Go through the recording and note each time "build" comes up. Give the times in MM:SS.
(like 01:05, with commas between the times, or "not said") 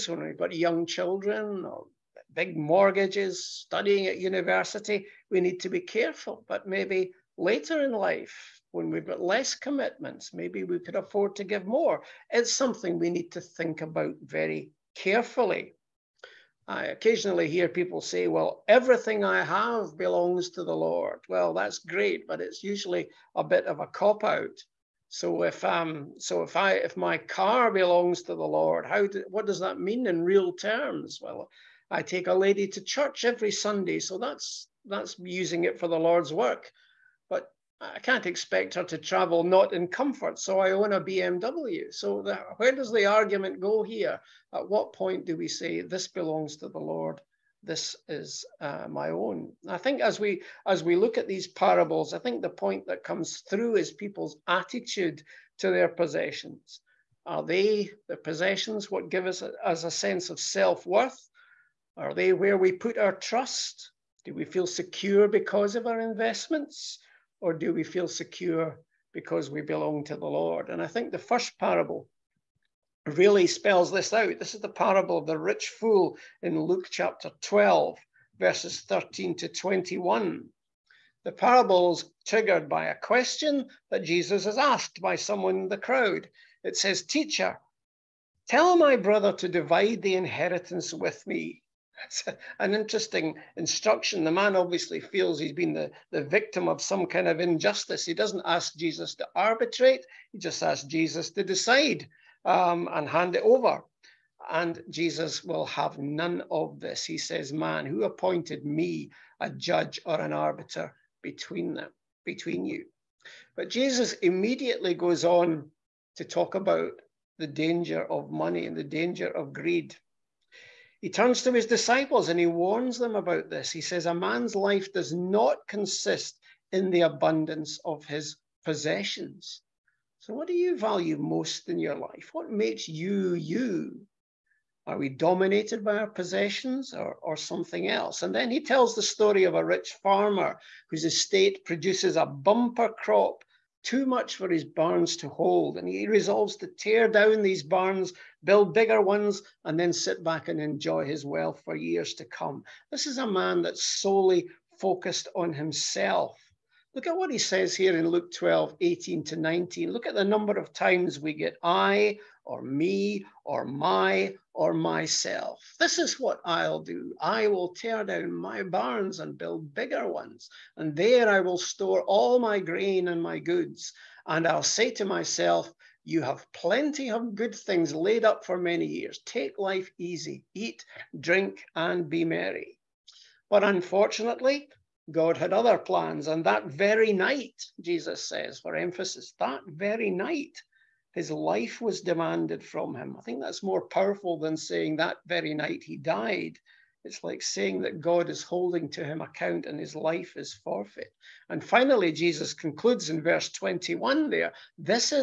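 02:28, 02:49.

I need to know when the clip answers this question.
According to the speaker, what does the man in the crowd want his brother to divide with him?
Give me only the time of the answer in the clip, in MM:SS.
01:30.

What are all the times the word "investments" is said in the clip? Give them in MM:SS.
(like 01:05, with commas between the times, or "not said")
01:05.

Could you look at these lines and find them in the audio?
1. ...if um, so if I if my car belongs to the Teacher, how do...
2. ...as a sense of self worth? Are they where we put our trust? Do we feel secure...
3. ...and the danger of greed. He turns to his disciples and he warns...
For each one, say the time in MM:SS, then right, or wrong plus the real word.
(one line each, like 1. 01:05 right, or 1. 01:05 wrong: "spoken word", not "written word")
1. 00:25 wrong: "Lord", not "Teacher"
2. 00:59 right
3. 01:58 right.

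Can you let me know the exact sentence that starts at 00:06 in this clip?
But maybe later in life, when we've got less commitments, maybe we could afford to give more.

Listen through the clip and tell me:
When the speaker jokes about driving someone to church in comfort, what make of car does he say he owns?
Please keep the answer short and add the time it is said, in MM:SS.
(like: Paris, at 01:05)
BMW, at 00:41.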